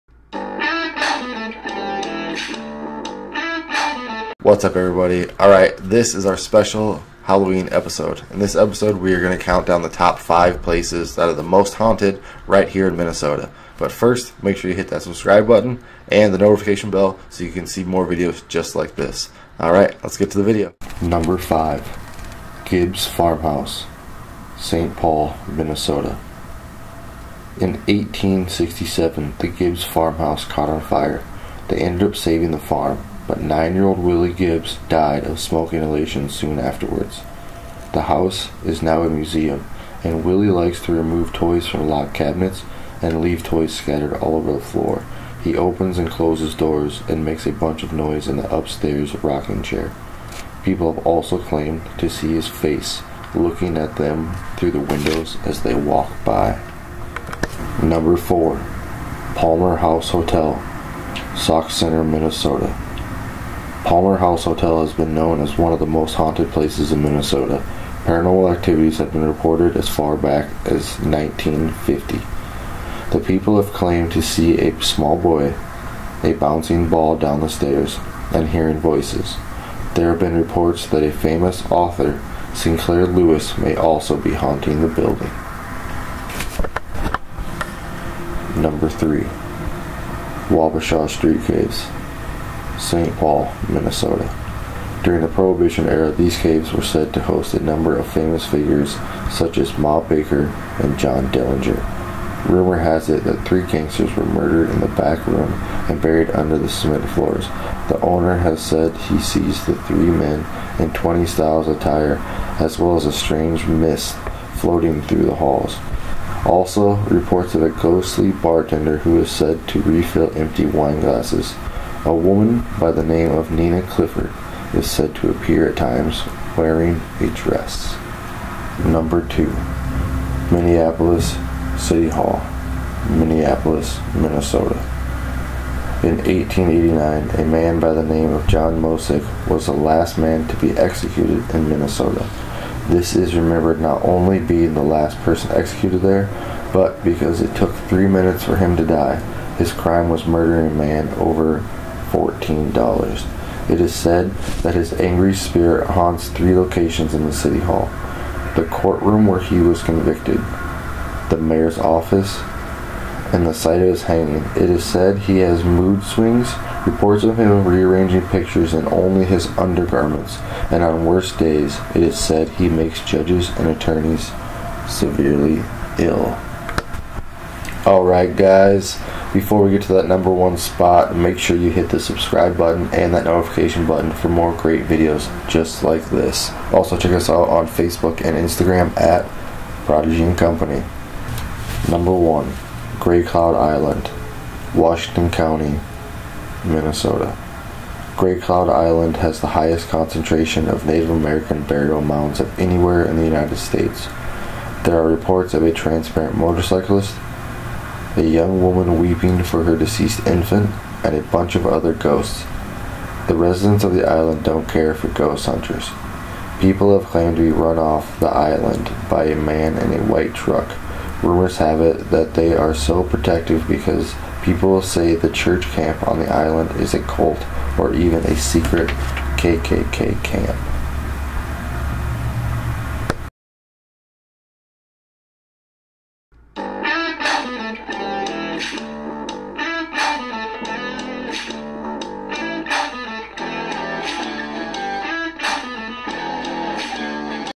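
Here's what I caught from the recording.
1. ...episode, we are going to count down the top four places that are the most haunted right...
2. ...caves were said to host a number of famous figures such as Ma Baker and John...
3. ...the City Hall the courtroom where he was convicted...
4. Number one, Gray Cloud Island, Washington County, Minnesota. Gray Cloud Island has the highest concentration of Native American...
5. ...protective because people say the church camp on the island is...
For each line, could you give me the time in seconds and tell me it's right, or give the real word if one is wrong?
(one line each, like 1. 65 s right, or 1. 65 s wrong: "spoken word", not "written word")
1. 8 s wrong: "five", not "four"
2. 96 s right
3. 157 s right
4. 191 s right
5. 223 s right.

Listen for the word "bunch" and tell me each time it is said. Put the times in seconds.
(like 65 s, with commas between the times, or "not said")
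47 s, 211 s.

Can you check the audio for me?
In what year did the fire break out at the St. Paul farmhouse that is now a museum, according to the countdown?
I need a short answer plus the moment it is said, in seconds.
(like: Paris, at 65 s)
1867, at 27 s.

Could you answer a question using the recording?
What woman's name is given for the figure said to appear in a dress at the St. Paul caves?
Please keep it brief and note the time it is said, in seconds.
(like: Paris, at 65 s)
Nina Clifford, at 123 s.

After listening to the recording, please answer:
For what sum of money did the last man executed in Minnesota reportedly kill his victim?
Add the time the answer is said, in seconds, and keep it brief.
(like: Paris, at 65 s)
$14, at 152 s.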